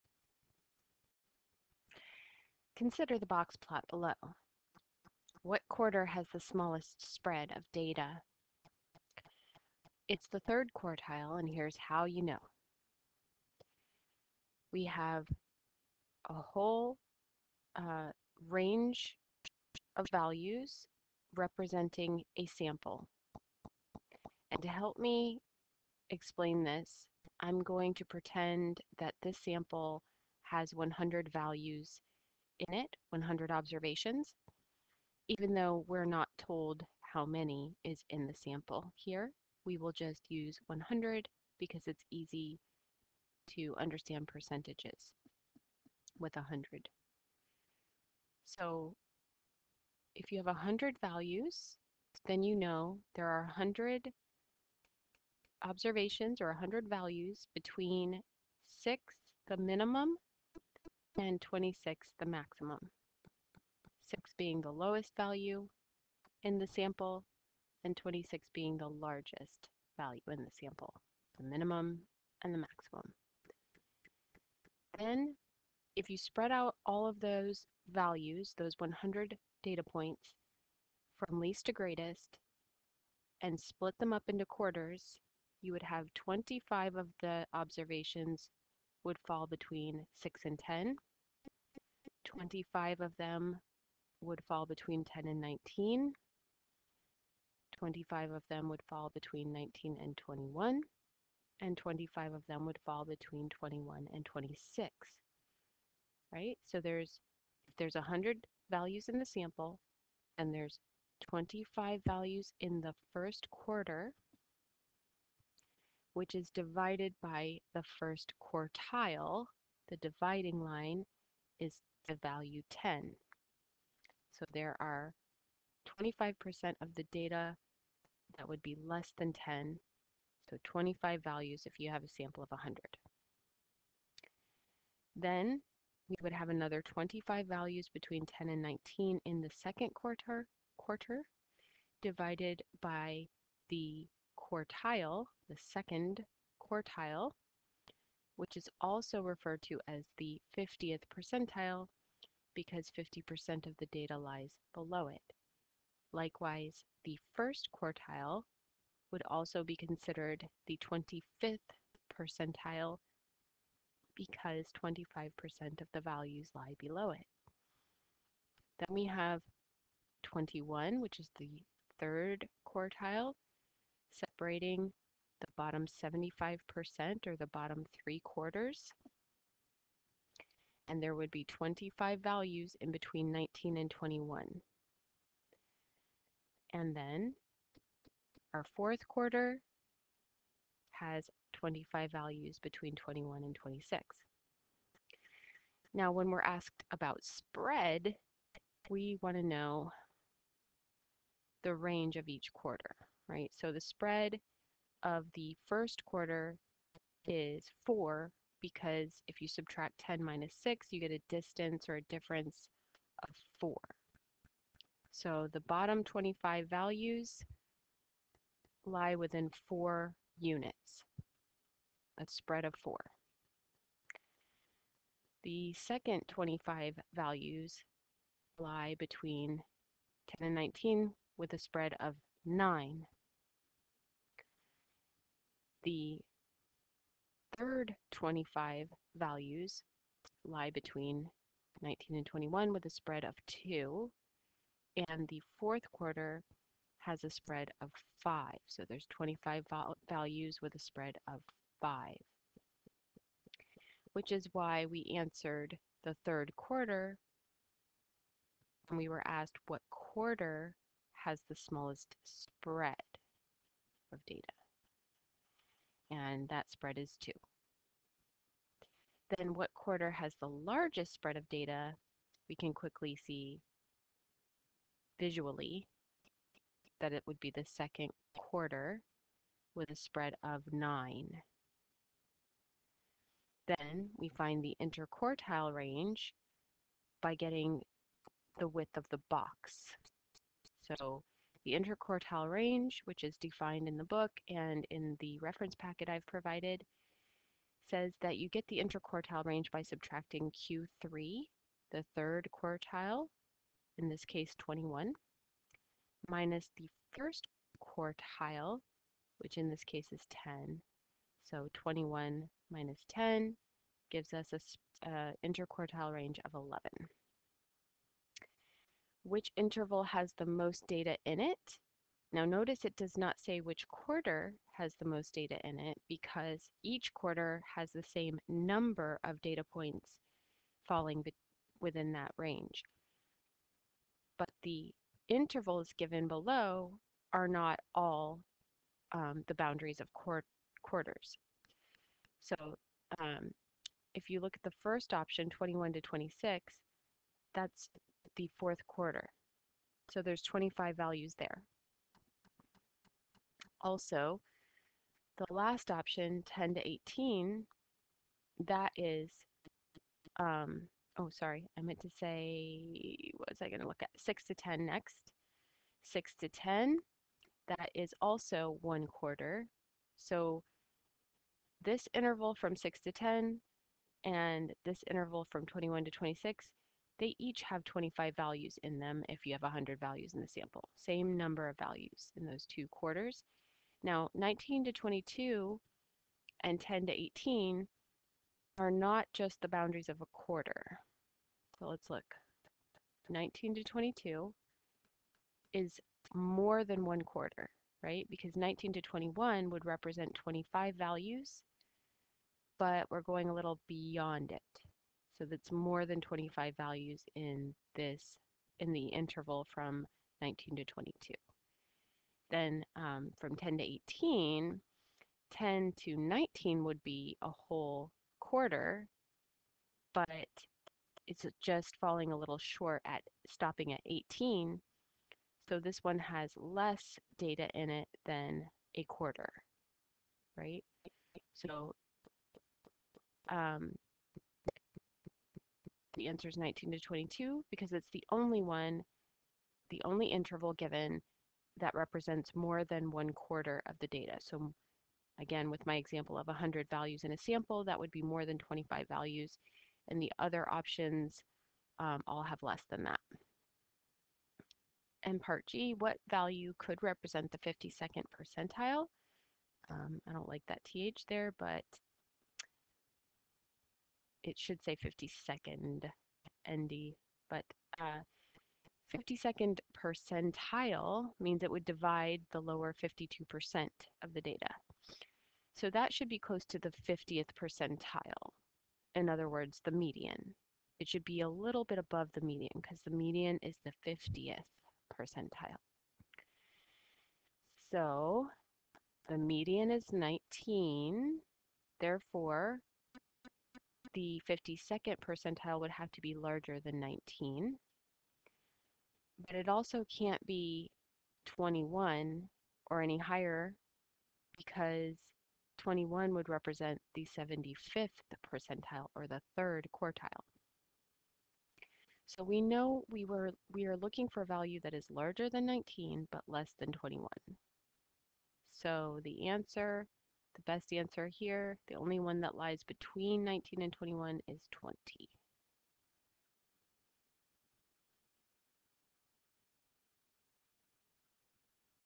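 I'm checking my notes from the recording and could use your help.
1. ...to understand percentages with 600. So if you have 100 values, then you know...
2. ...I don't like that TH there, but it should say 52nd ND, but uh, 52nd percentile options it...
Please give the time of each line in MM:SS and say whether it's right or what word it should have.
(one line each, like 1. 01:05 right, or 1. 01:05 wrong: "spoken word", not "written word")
1. 00:43 wrong: "100", not "600"
2. 07:40 wrong: "means", not "options".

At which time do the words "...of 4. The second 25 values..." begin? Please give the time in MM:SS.
03:42.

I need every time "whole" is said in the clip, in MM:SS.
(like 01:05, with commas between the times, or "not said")
00:16, 06:57.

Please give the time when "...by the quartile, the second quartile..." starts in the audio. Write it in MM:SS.
02:22.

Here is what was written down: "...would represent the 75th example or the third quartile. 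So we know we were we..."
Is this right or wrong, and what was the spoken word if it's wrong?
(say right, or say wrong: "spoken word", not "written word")
wrong: "percentile", not "example".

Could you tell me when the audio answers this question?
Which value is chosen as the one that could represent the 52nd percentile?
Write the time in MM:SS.
08:44.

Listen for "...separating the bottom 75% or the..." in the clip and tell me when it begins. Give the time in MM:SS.
02:54.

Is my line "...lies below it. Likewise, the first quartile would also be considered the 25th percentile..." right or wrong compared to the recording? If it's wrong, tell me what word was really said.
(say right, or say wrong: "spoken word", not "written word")
right.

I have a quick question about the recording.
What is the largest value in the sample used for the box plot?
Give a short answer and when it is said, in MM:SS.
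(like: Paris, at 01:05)
26, at 01:01.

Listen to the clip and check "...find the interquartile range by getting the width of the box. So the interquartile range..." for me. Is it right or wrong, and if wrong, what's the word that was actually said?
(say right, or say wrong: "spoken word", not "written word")
right.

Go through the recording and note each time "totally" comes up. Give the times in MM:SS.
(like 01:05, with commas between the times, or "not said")
not said.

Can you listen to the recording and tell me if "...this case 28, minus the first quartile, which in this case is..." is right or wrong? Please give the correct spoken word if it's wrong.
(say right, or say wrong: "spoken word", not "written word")
wrong: "21", not "28".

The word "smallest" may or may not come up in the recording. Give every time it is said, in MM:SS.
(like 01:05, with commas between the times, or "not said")
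00:06, 04:21.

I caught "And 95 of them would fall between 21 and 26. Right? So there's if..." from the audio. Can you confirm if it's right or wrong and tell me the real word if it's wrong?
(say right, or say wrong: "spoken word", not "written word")
wrong: "25", not "95".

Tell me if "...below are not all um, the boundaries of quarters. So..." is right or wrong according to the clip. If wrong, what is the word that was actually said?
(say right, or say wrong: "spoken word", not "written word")
right.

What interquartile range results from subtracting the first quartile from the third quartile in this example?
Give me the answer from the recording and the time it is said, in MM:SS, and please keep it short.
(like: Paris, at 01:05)
11, at 05:16.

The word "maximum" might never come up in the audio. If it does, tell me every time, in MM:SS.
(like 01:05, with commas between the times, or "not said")
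01:02, 01:12.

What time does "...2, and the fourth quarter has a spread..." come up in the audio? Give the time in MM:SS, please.
04:03.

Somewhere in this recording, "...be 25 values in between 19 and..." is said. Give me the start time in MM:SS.
03:01.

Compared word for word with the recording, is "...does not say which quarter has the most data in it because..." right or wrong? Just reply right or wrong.
right.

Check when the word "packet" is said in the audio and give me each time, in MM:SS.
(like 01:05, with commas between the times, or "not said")
04:55.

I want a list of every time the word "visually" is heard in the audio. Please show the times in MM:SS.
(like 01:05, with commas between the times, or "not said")
04:35.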